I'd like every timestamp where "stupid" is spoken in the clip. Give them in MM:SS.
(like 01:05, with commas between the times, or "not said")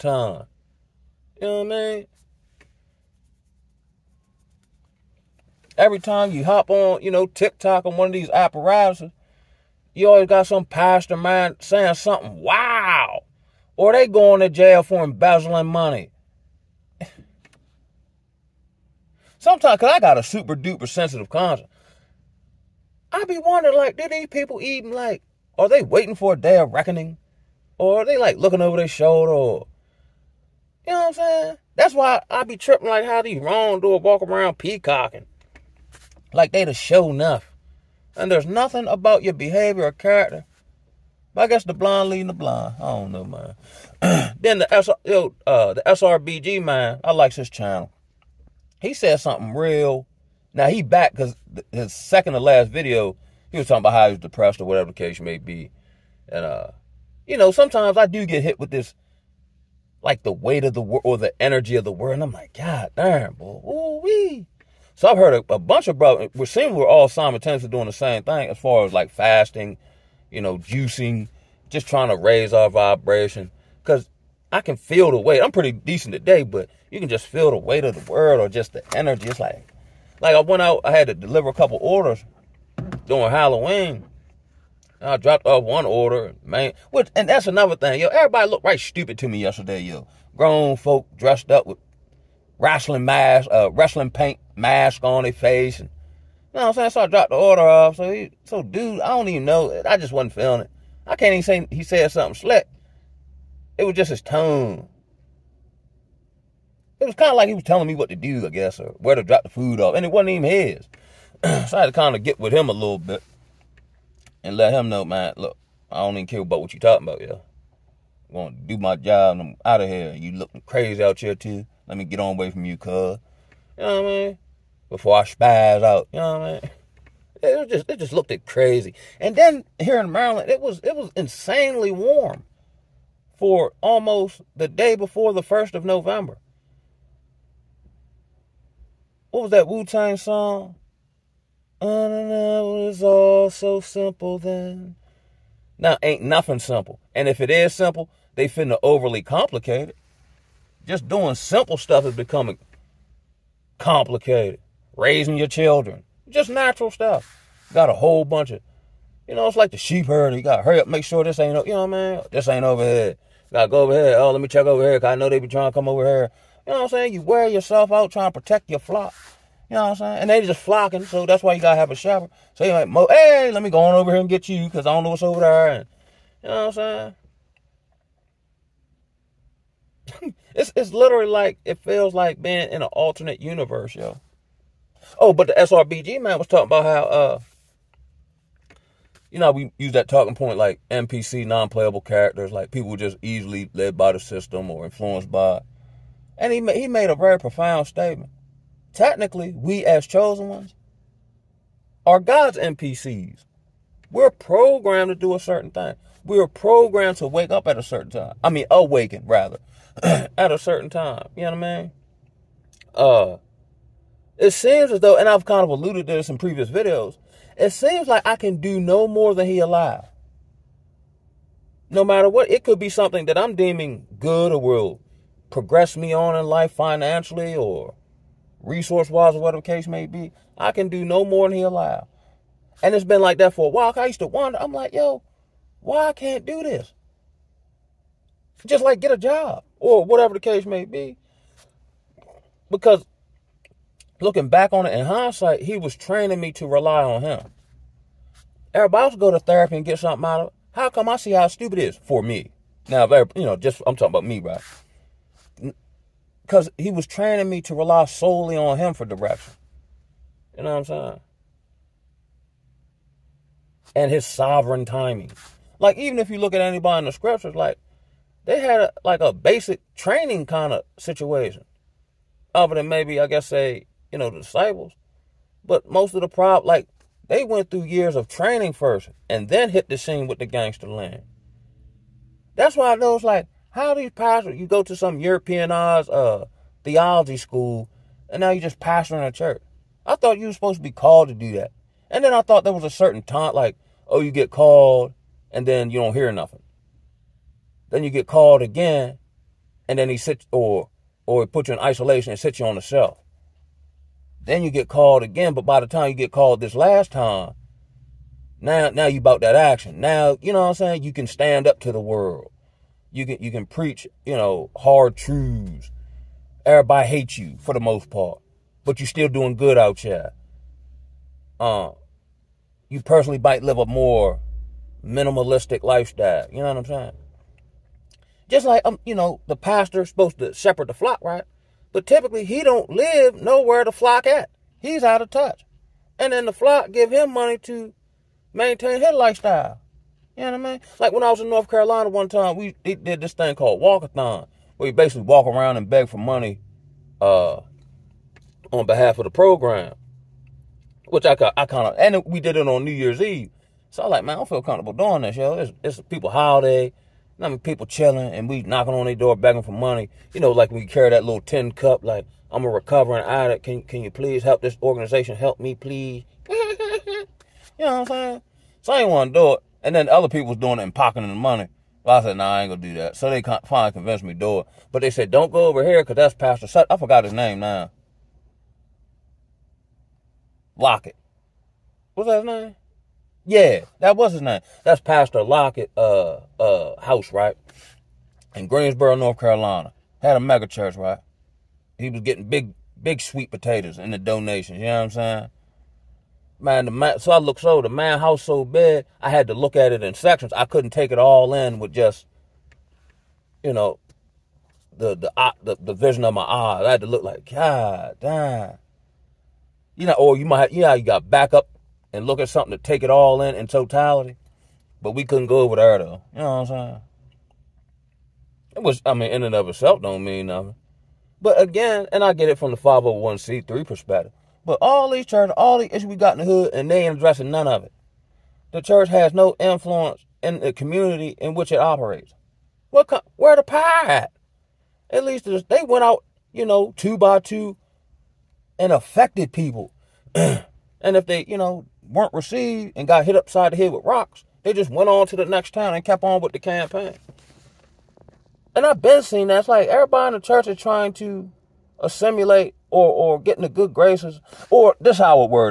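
01:28, 04:11.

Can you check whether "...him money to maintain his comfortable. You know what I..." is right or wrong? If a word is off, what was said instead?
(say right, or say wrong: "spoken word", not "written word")
wrong: "lifestyle", not "comfortable".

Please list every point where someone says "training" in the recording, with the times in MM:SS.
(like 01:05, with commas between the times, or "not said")
04:05, 04:17, 04:29, 04:38.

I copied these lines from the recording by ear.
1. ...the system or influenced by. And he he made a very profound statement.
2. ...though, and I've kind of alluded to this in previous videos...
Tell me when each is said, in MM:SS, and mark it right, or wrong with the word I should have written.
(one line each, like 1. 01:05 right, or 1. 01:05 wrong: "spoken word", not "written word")
1. 03:14 right
2. 03:34 right.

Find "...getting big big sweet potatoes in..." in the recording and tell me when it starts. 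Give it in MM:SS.
06:32.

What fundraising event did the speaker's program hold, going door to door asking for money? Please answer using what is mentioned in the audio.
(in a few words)
walkathon.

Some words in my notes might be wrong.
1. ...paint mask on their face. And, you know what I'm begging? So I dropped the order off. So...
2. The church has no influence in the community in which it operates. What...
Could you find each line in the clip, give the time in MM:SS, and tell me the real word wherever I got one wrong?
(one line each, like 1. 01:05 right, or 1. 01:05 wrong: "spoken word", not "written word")
1. 01:34 wrong: "saying", not "begging"
2. 07:08 right.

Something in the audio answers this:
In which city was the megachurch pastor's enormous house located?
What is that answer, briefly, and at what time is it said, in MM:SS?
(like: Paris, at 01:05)
Greensboro, at 06:28.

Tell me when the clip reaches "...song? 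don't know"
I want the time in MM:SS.
02:20.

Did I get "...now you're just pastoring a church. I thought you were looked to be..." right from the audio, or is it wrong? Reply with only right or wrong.
wrong.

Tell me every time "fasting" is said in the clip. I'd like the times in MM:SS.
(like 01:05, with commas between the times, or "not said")
01:09.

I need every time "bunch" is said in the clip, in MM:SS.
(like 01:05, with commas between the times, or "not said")
01:05, 02:38.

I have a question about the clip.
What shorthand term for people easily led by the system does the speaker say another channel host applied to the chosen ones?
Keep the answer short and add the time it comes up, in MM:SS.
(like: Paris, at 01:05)
NPC, at 03:10.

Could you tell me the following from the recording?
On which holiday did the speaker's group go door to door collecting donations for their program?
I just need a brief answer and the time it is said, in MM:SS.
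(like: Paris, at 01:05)
New Year's Eve, at 05:52.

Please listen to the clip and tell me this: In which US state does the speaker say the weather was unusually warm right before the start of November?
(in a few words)
Maryland.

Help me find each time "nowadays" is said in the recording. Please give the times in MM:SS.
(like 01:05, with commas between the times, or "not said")
not said.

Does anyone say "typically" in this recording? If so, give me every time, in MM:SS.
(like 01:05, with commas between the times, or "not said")
05:32.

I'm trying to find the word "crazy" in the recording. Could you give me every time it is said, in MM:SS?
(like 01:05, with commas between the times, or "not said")
02:00, 02:08.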